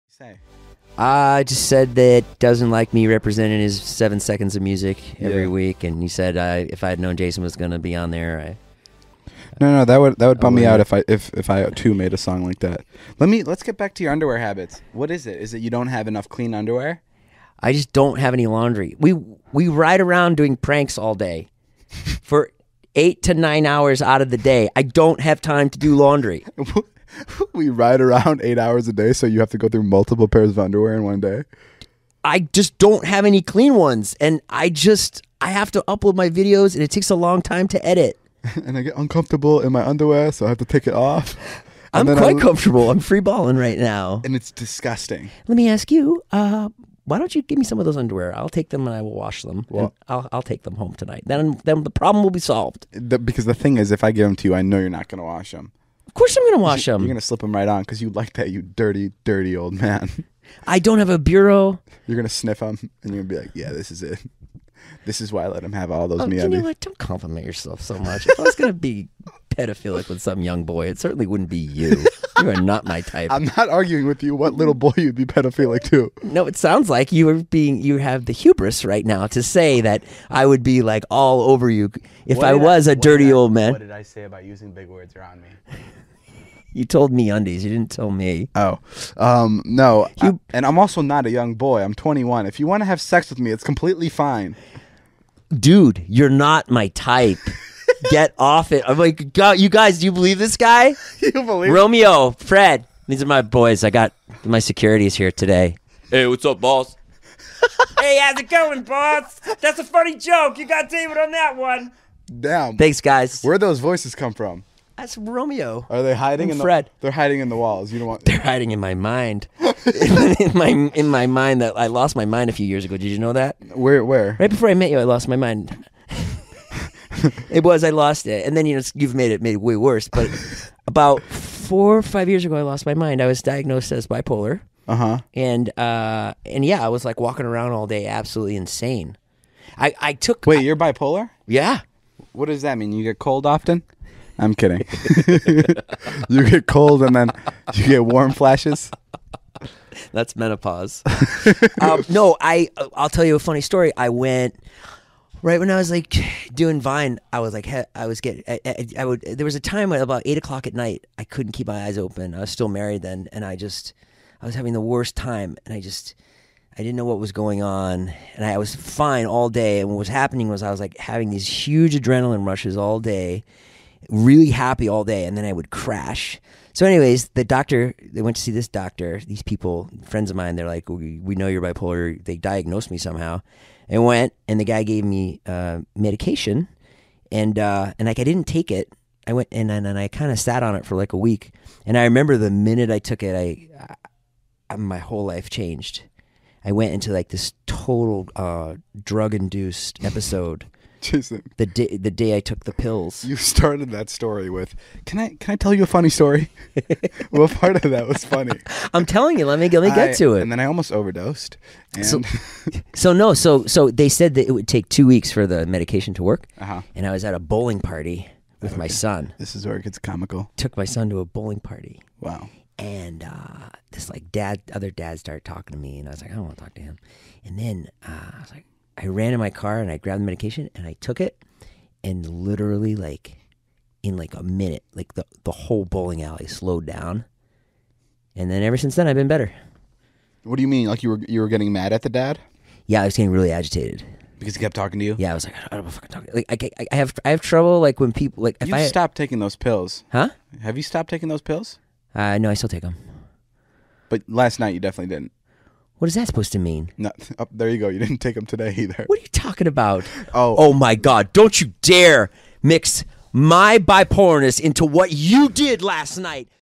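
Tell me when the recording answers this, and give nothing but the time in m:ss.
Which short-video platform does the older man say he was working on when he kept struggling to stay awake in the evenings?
2:36.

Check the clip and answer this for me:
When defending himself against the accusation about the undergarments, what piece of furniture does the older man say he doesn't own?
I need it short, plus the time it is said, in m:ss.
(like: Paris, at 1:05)
A bureau, at 1:01.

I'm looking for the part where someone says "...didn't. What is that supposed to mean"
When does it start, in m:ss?
4:15.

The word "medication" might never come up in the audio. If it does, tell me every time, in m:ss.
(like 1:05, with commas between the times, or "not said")
3:05, 3:35, 3:50.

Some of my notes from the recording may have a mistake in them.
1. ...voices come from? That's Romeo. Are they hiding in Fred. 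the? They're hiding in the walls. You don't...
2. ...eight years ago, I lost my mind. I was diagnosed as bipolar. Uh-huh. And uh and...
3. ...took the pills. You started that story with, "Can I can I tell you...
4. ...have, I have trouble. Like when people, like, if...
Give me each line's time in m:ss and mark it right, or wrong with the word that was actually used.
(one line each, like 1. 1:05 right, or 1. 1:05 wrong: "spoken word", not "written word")
1. 1:53 right
2. 2:12 wrong: "five", not "eight"
3. 3:22 right
4. 4:06 right.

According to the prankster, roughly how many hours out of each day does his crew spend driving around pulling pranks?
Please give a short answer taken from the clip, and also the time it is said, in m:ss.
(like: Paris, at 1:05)
8 to 9 hours, at 0:22.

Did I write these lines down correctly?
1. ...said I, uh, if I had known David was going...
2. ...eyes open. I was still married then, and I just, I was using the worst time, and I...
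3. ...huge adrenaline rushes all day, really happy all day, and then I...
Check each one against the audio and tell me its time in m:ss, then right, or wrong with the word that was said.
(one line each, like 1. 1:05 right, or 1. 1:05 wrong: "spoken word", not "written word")
1. 0:06 wrong: "Jason", not "David"
2. 2:41 wrong: "having", not "using"
3. 2:51 right.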